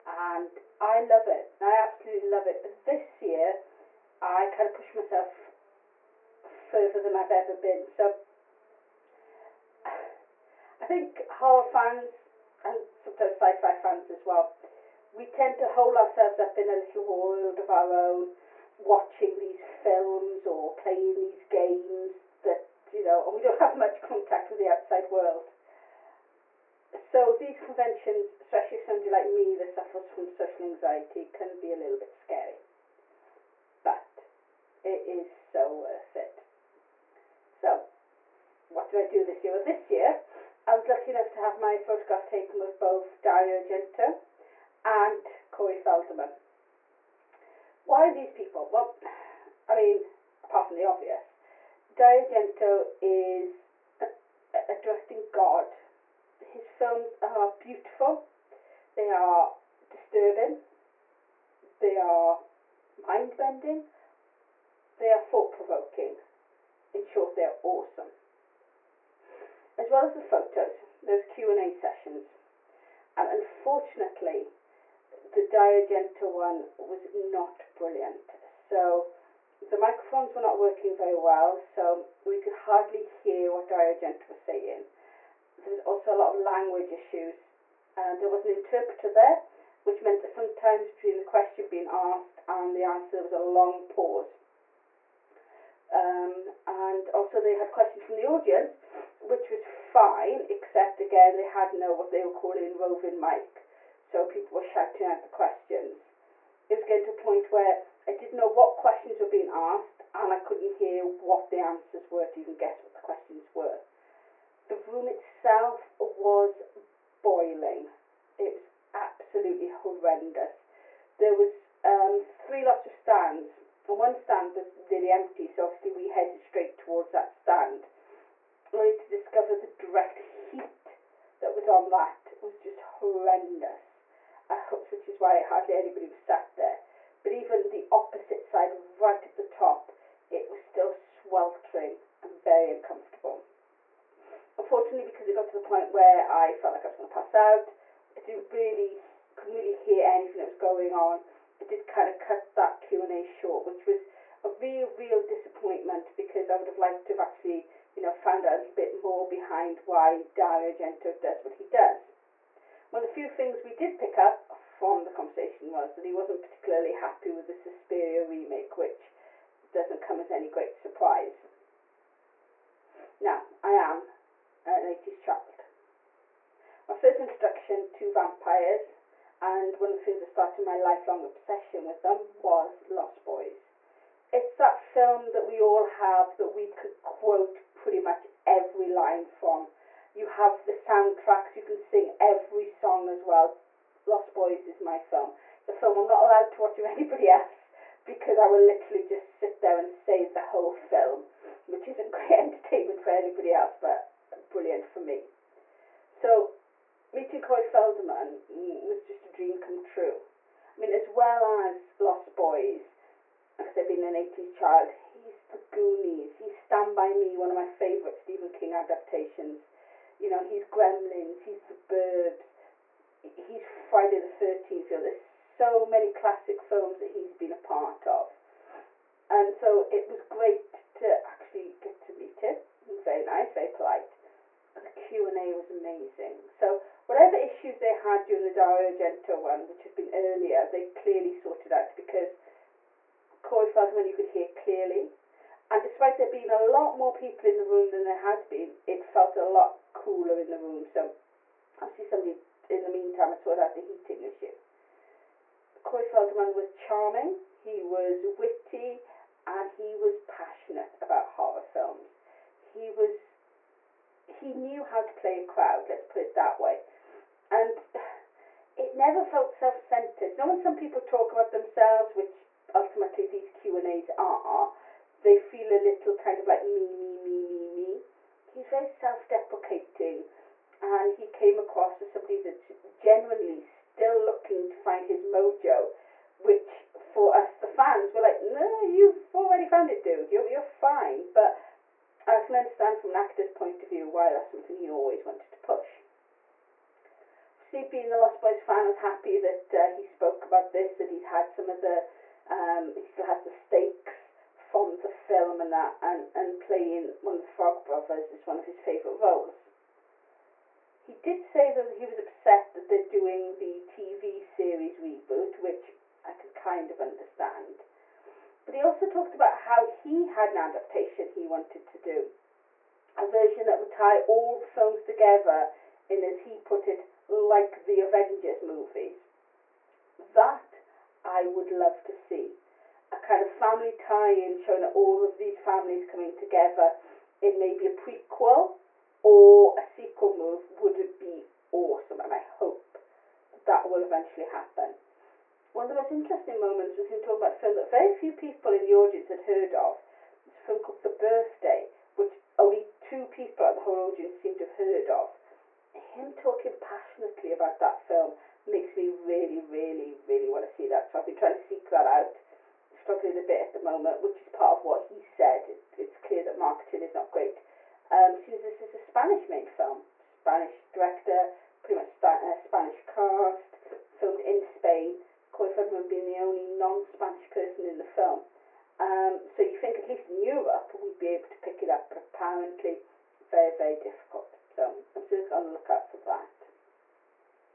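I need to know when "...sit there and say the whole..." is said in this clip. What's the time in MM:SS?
03:19.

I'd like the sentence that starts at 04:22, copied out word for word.
He was he knew how to play a crowd, let's put it that way.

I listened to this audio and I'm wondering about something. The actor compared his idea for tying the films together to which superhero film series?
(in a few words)
The Avengers.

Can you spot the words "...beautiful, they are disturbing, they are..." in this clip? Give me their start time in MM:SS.
00:57.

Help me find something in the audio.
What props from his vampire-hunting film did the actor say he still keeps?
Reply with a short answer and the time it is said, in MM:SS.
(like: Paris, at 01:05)
The stakes, at 05:03.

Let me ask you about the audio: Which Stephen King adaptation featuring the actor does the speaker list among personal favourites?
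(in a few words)
Stand By Me.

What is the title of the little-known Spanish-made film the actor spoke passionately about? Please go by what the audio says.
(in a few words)
The Birthday.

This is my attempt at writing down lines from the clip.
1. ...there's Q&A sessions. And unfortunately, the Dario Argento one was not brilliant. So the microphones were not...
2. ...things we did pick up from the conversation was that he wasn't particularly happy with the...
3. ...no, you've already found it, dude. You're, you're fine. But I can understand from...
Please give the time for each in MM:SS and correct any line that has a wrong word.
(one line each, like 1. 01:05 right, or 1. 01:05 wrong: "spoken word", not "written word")
1. 01:11 right
2. 02:43 right
3. 04:48 right.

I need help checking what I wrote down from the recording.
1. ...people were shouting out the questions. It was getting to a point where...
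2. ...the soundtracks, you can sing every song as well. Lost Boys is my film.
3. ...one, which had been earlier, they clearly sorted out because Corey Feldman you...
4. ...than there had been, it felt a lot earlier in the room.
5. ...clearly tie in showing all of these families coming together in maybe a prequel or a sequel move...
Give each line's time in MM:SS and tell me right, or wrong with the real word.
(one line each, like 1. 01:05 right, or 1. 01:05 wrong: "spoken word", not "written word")
1. 01:44 right
2. 03:10 right
3. 03:59 right
4. 04:07 wrong: "cooler", not "earlier"
5. 05:33 wrong: "family", not "clearly".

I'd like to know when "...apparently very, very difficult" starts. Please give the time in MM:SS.
06:22.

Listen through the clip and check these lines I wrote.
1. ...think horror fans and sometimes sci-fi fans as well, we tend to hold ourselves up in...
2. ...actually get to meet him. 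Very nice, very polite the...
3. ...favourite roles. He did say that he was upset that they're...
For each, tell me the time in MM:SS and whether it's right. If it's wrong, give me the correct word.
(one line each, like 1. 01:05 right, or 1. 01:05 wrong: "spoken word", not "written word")
1. 00:10 right
2. 03:51 right
3. 05:08 right.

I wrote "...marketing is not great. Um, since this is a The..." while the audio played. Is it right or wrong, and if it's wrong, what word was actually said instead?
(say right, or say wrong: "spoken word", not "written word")
wrong: "Spanish", not "The".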